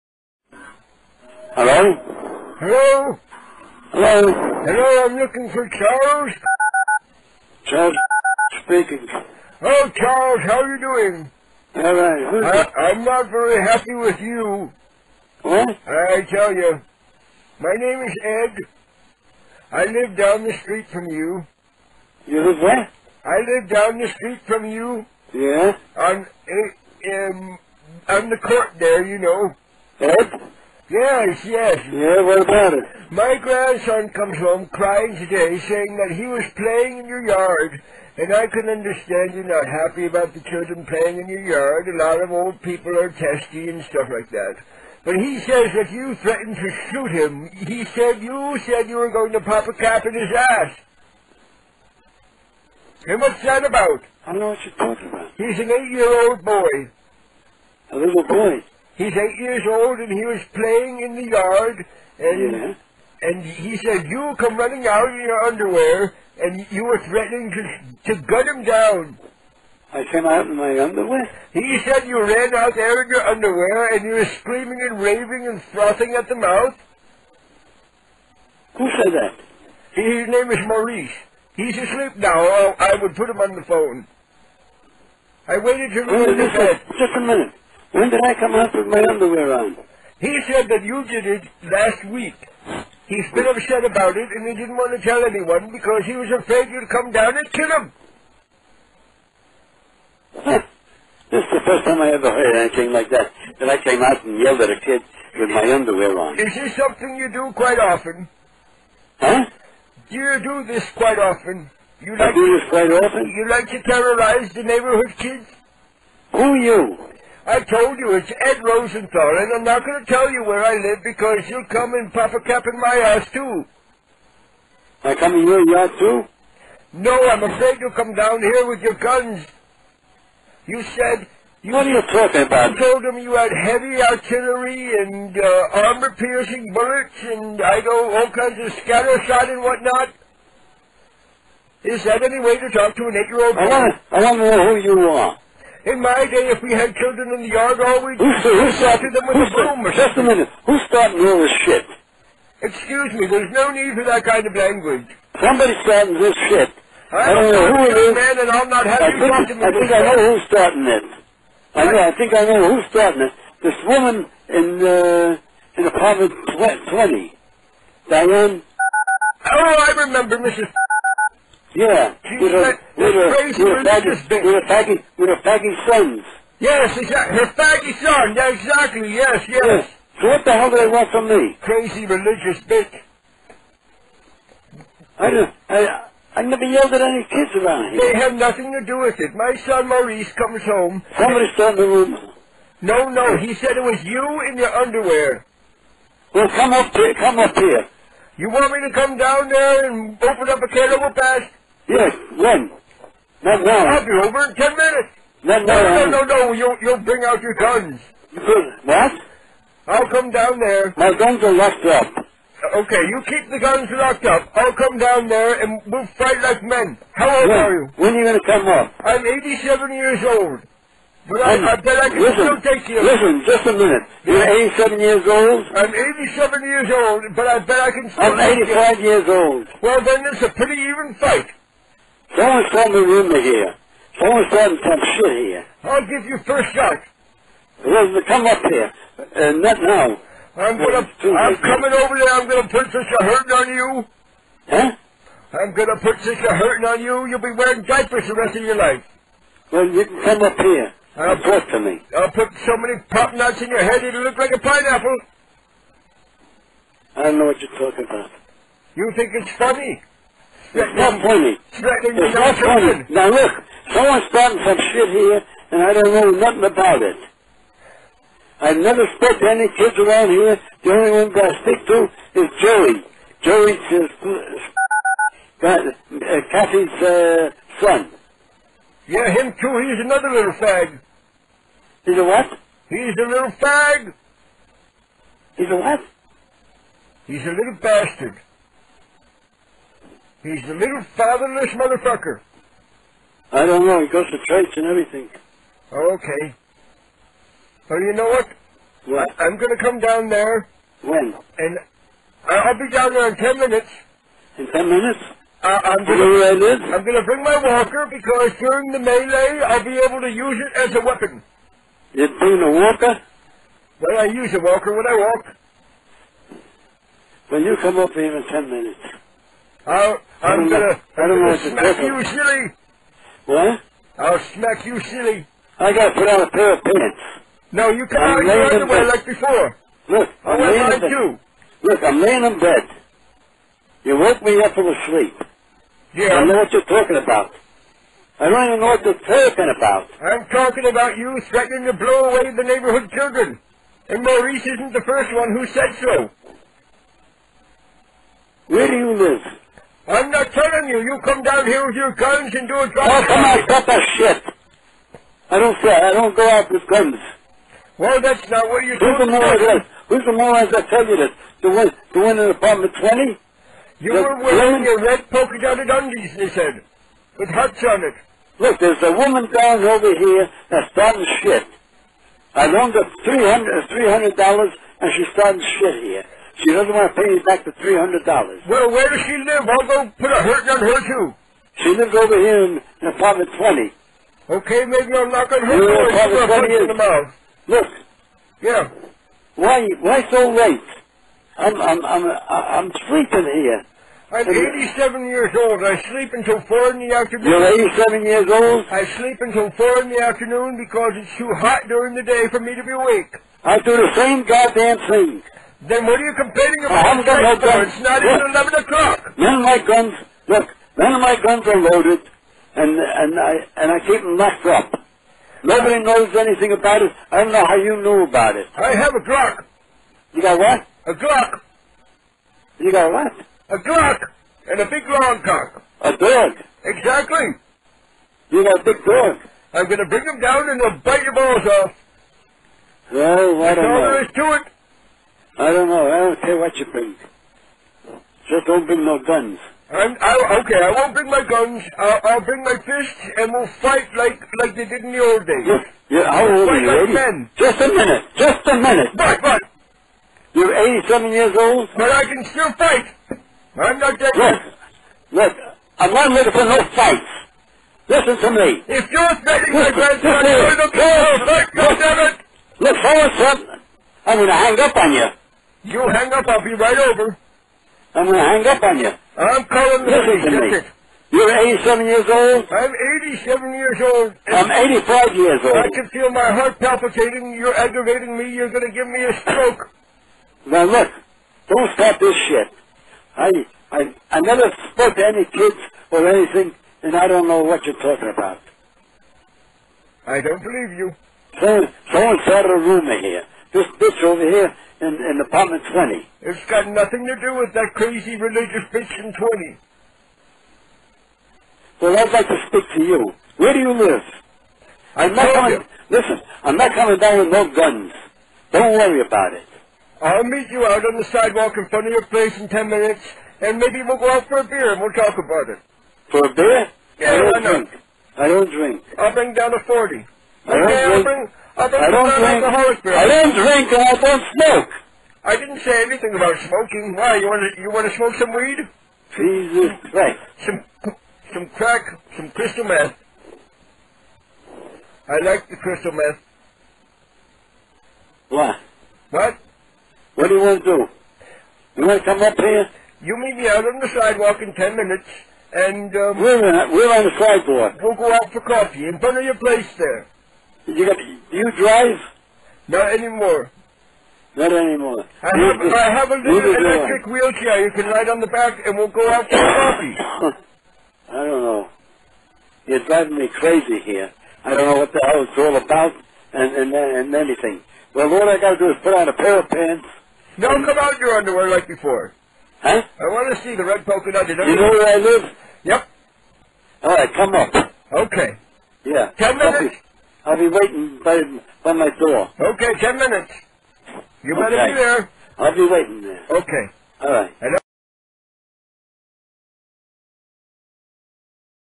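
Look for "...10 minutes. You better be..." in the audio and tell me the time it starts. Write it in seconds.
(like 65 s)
582 s.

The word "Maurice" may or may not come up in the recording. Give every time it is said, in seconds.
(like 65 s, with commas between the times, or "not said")
80 s, 189 s, 344 s.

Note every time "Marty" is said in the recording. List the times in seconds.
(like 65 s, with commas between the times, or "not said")
not said.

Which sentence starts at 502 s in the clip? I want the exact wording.
Well, I'd like to speak to you.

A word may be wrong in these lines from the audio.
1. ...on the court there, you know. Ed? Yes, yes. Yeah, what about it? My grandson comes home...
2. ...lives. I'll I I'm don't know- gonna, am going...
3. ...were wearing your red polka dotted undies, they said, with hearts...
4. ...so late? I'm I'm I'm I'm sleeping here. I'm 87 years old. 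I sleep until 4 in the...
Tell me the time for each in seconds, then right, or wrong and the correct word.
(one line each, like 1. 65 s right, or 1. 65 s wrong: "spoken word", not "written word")
1. 28 s right
2. 318 s wrong: "minutes", not "lives"
3. 364 s right
4. 390 s right.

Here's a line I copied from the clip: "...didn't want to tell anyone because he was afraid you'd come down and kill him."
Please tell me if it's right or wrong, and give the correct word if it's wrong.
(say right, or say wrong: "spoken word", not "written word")
right.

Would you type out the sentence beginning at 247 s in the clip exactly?
You'll be wearing diapers the rest of your life.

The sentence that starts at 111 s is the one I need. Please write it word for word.
You like I do this quite often?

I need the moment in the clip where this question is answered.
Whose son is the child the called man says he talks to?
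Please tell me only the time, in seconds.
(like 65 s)
276 s.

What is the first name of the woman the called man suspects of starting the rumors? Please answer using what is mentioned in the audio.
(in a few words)
Diane.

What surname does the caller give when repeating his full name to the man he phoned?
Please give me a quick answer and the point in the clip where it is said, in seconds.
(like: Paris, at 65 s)
Rosenthal, at 118 s.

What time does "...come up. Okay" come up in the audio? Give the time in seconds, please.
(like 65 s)
577 s.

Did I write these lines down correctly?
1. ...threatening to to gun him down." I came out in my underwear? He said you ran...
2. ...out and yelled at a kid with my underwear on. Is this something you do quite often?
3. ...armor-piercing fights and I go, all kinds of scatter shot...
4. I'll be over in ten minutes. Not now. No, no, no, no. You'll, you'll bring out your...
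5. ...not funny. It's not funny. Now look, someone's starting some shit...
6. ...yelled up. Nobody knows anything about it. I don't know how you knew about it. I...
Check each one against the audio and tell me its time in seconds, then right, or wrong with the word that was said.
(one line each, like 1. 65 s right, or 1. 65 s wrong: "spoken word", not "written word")
1. 66 s right
2. 104 s right
3. 135 s wrong: "bullets", not "fights"
4. 203 s right
5. 260 s right
6. 414 s wrong: "locked", not "yelled".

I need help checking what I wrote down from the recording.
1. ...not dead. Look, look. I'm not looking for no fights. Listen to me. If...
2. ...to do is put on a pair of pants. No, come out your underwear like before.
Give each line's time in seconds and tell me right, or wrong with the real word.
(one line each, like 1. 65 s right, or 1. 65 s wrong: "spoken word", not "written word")
1. 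453 s right
2. 568 s right.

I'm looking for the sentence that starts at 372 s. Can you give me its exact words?
I loaned her $300, $300 and she's starting shit here.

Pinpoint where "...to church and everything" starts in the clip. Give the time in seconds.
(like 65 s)
294 s.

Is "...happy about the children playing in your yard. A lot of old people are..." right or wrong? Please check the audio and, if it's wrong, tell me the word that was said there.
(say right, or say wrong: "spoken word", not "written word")
right.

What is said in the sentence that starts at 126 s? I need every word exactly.
No, I'm afraid you'll come down here with your guns.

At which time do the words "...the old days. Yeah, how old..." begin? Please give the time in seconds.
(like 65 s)
445 s.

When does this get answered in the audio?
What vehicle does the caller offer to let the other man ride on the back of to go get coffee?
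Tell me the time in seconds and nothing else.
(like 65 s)
556 s.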